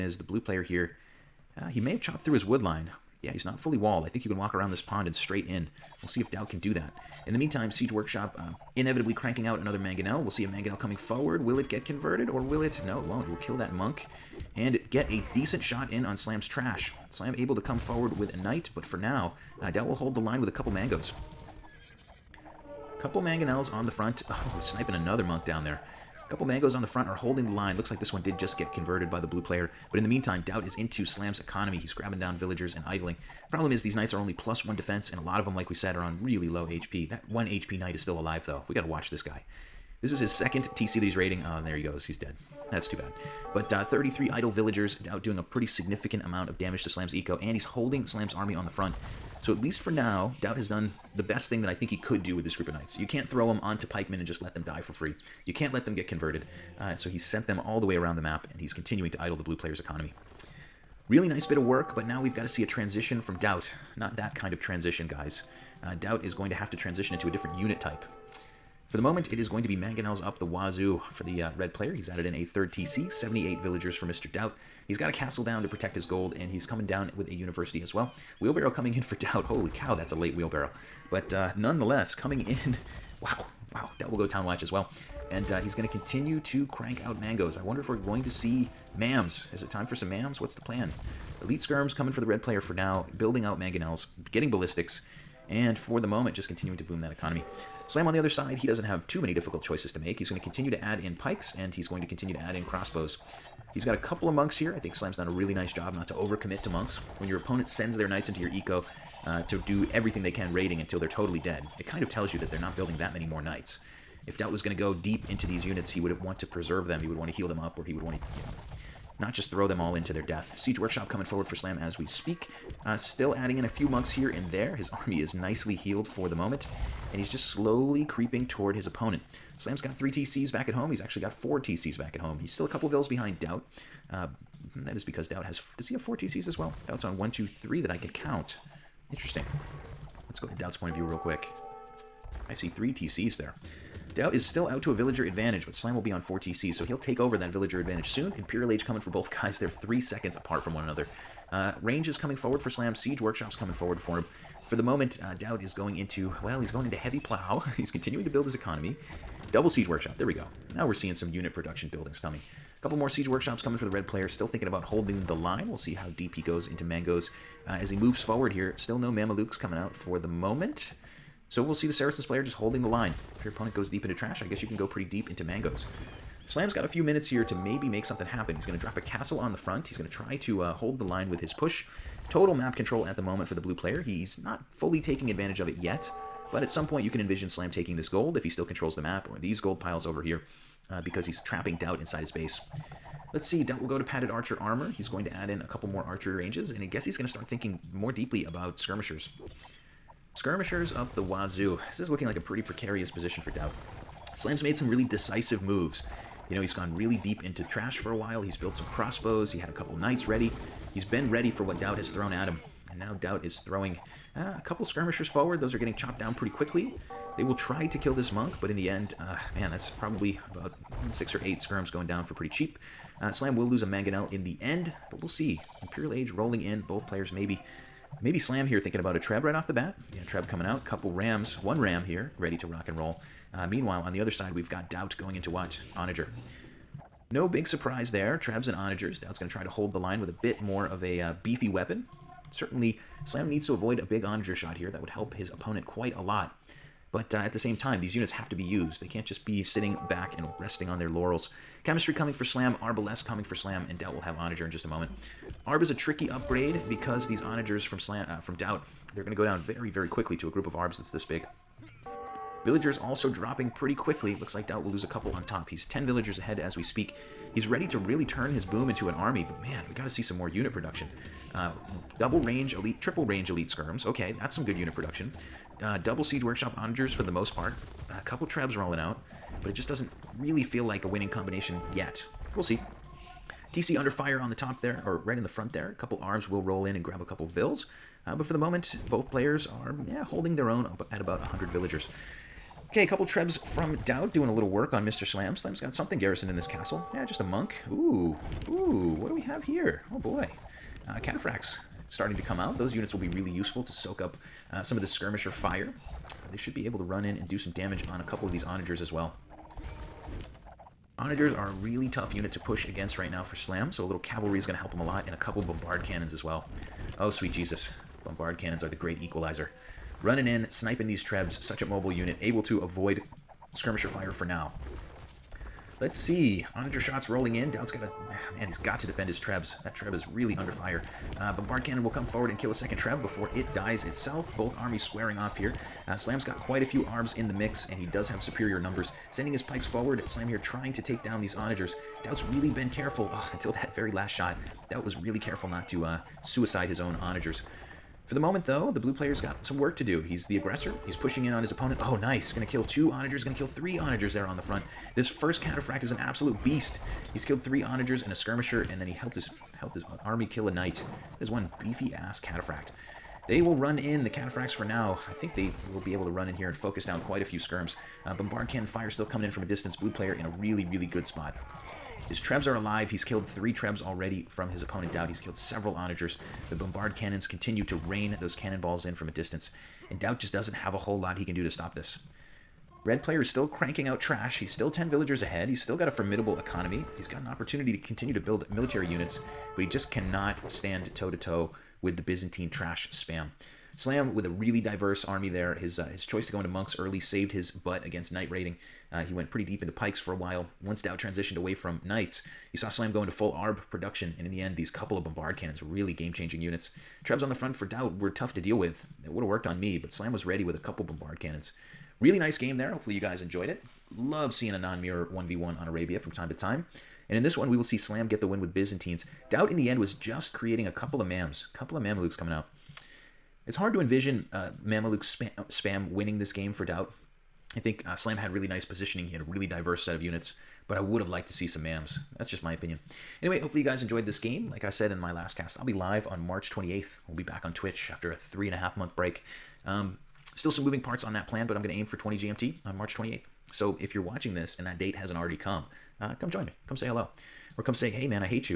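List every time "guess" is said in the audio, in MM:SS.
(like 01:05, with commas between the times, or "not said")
02:54, 03:16.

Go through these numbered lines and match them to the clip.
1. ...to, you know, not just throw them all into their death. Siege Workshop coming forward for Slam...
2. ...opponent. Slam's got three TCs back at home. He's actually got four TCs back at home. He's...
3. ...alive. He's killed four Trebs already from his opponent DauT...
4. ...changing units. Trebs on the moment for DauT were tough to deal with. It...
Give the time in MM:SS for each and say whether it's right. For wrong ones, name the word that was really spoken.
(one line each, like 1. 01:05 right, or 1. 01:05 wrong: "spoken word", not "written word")
1. 01:58 right
2. 02:08 right
3. 06:12 wrong: "three", not "four"
4. 06:46 wrong: "front", not "moment".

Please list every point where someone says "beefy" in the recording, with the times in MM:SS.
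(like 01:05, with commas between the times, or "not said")
04:01, 06:01.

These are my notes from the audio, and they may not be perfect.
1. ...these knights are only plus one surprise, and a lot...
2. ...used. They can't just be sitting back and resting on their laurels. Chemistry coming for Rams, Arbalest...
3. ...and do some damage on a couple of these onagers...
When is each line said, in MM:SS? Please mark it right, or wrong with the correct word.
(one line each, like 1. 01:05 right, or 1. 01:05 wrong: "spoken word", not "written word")
1. 00:33 wrong: "defense", not "surprise"
2. 04:08 wrong: "Slam", not "Rams"
3. 05:07 right.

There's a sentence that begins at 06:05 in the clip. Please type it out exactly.
I think they will be able to run in here and focus down quite a few skirms.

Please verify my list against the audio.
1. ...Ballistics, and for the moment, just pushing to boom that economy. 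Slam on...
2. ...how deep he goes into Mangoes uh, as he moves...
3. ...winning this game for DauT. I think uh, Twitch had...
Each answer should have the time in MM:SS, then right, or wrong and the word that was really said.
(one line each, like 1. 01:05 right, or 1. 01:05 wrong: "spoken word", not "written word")
1. 01:34 wrong: "continuing", not "pushing"
2. 02:45 right
3. 07:06 wrong: "Slam", not "Twitch".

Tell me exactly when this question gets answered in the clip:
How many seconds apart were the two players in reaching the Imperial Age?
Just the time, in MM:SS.
02:29.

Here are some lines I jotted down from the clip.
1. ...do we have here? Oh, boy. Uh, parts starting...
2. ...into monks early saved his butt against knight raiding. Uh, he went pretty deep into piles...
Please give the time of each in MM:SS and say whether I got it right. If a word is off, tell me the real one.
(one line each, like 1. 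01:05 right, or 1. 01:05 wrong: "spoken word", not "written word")
1. 04:59 wrong: "cataphracts", not "parts"
2. 06:36 wrong: "pikes", not "piles".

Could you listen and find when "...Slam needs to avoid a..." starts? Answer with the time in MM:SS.
04:03.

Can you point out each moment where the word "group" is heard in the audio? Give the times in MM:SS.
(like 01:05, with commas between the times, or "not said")
00:52, 04:20.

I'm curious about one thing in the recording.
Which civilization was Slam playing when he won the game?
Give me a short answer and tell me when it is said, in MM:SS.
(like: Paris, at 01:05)
Byzantines, at 06:58.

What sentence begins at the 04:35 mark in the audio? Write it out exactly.
Uh, double Siege Workshop onagers for the most part.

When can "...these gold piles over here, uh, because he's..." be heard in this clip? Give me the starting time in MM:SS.
03:09.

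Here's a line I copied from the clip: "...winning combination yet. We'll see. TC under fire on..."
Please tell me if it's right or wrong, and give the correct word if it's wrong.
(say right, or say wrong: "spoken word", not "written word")
right.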